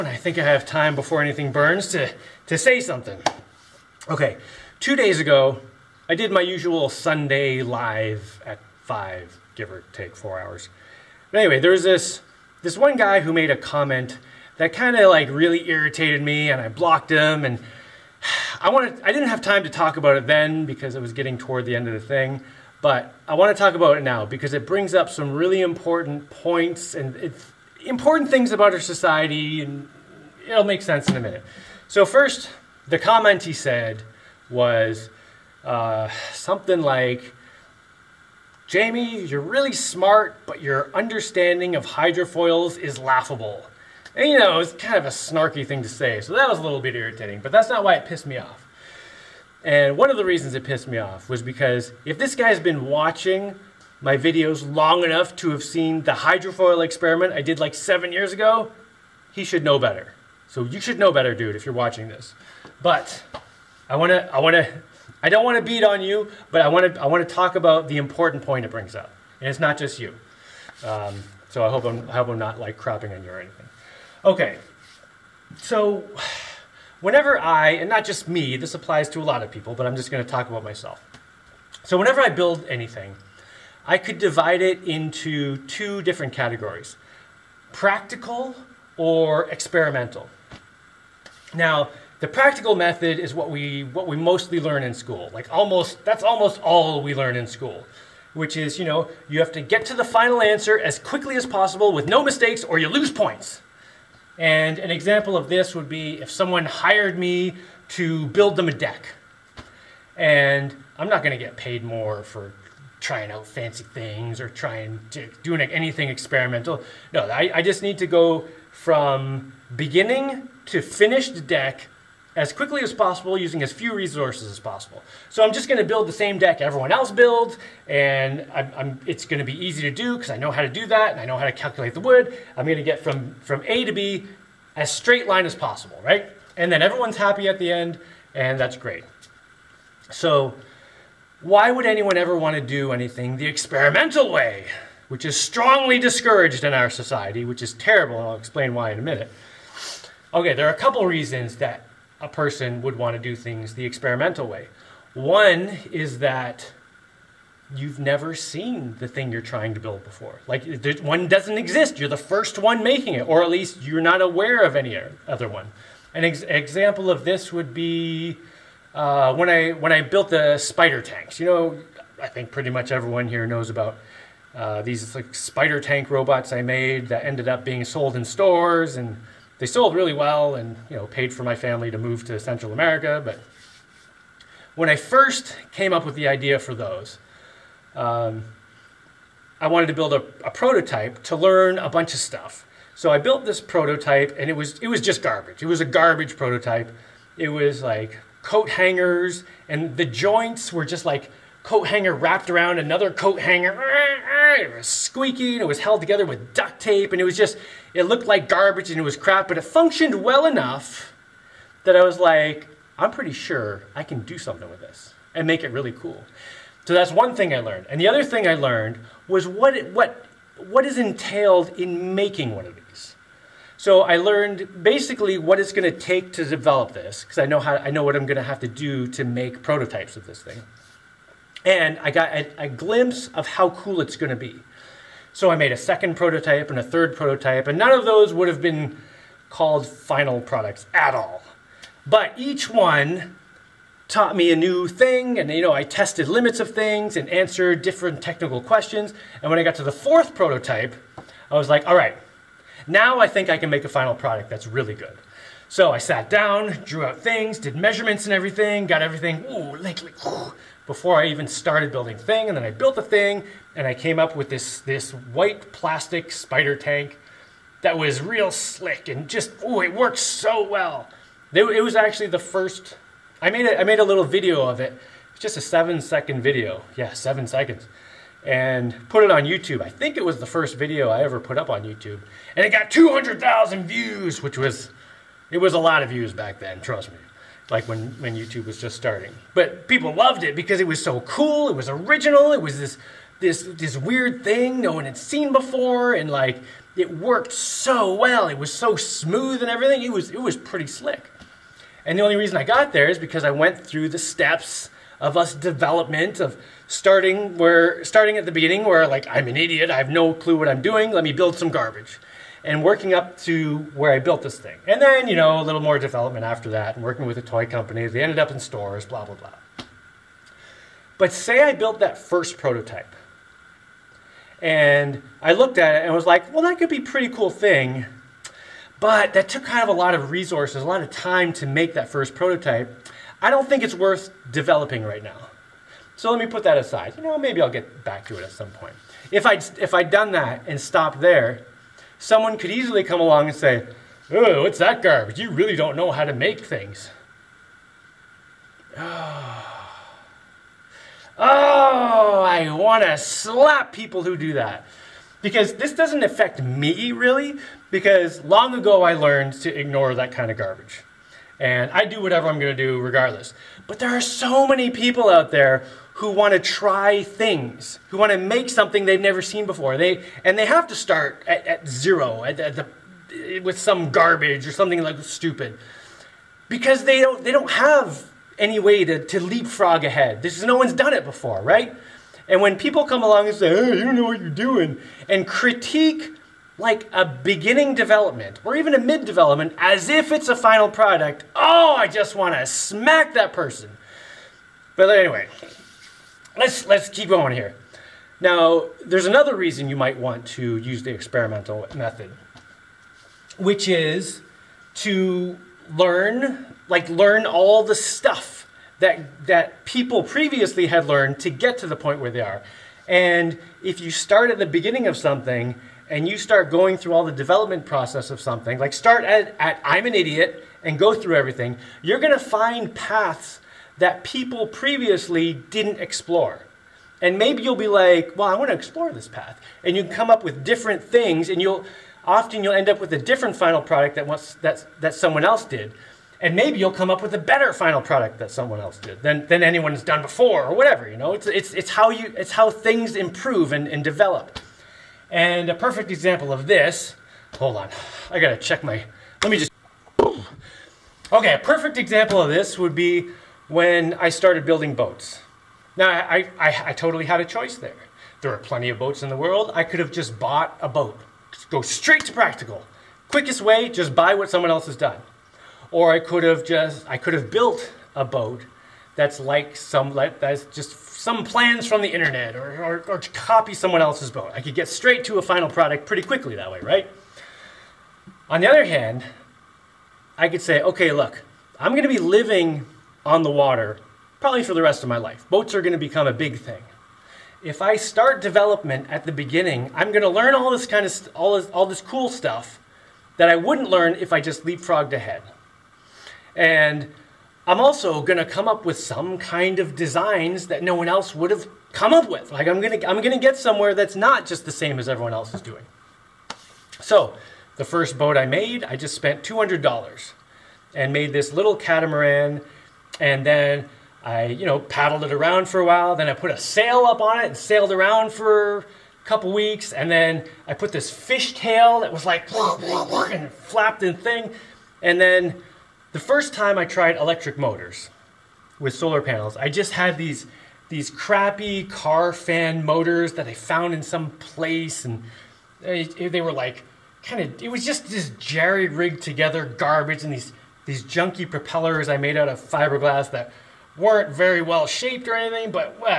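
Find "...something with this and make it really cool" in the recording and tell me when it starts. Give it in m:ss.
3:34.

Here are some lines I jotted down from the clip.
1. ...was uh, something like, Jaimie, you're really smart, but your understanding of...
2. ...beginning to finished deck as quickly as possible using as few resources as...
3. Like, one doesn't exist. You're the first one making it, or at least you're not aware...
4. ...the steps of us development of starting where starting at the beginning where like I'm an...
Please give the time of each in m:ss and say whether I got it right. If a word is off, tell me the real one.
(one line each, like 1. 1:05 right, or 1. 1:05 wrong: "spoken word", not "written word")
1. 0:34 right
2. 1:59 right
3. 2:40 right
4. 5:04 right.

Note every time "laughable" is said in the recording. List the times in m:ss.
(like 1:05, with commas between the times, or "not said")
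0:42.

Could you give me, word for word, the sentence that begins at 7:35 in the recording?
Now, I, I, I totally had a choice there.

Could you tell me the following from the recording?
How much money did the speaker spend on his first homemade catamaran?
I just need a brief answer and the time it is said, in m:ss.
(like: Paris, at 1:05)
$200, at 8:29.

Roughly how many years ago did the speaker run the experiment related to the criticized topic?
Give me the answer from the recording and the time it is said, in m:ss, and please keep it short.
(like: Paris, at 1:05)
7, at 0:57.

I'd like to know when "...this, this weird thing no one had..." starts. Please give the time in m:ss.
4:53.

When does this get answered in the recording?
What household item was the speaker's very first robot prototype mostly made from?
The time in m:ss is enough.
3:18.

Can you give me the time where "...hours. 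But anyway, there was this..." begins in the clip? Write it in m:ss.
0:10.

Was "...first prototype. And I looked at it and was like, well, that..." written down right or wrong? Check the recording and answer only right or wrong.
right.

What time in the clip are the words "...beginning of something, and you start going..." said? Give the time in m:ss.
6:54.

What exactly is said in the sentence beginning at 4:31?
It was actually the first, I made, a, I made a little video of it.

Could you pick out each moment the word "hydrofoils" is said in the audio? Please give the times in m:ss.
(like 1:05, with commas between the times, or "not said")
0:41, 0:56.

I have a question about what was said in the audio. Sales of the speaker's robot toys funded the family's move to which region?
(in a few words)
Central America.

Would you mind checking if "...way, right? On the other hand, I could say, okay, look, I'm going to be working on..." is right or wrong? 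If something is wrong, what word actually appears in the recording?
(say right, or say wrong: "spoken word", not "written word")
wrong: "living", not "working".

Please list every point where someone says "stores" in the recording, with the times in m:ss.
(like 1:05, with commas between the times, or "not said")
2:58, 5:18.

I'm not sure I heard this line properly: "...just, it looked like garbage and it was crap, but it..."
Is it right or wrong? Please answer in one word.
right.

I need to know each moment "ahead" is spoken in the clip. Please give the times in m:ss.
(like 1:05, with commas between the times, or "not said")
6:20, 8:15.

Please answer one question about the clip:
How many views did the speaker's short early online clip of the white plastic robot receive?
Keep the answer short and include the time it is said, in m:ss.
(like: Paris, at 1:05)
200,000, at 4:42.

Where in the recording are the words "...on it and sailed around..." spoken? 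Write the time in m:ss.
8:37.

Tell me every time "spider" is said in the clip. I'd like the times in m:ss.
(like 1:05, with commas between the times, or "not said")
2:50, 2:55, 4:26.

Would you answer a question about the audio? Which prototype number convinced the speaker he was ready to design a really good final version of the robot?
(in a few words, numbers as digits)
4th.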